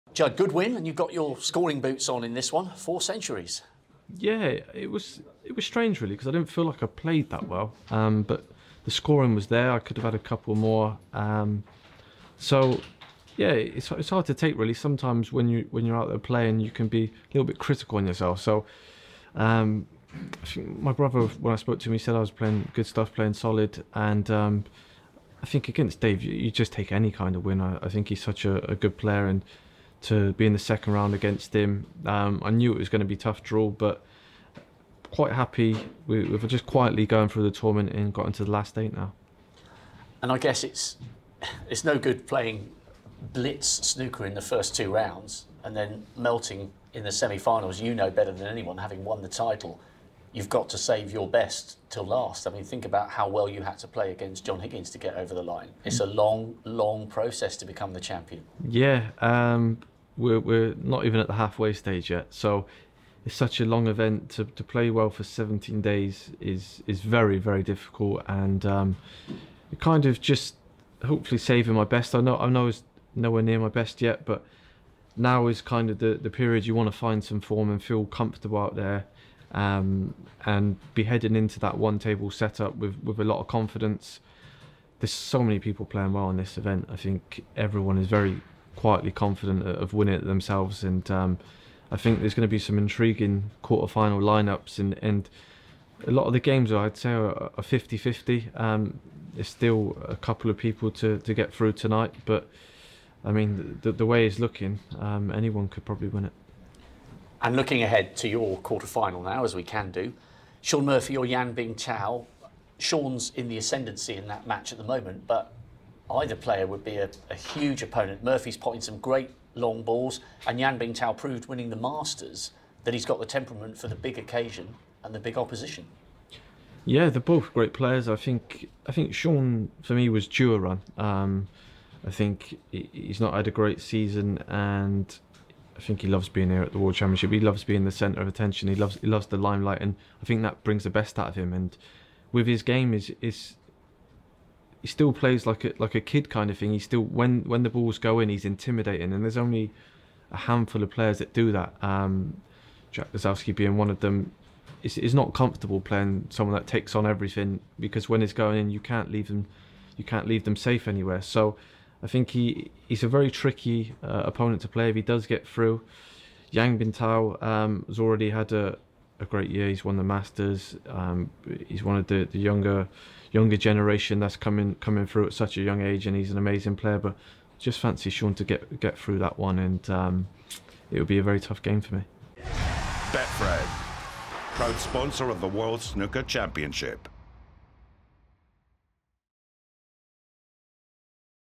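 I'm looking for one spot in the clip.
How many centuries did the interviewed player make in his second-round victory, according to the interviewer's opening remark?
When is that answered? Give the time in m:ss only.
0:02.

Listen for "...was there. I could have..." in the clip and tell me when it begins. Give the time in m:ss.
0:09.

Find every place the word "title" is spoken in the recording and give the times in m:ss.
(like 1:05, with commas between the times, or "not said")
0:49.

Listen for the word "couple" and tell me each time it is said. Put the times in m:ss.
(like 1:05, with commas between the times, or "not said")
0:10, 1:40.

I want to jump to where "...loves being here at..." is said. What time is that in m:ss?
2:16.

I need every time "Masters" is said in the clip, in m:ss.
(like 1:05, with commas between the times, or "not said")
2:01, 2:50.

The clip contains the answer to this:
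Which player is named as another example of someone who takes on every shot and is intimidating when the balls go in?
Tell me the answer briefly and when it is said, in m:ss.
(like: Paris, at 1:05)
Jack Lisowski, at 2:32.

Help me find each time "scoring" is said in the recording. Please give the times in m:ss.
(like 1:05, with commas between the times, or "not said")
0:01, 0:08.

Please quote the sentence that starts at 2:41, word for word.
So, I think he he's a very tricky uh, opponent to play if he does get through.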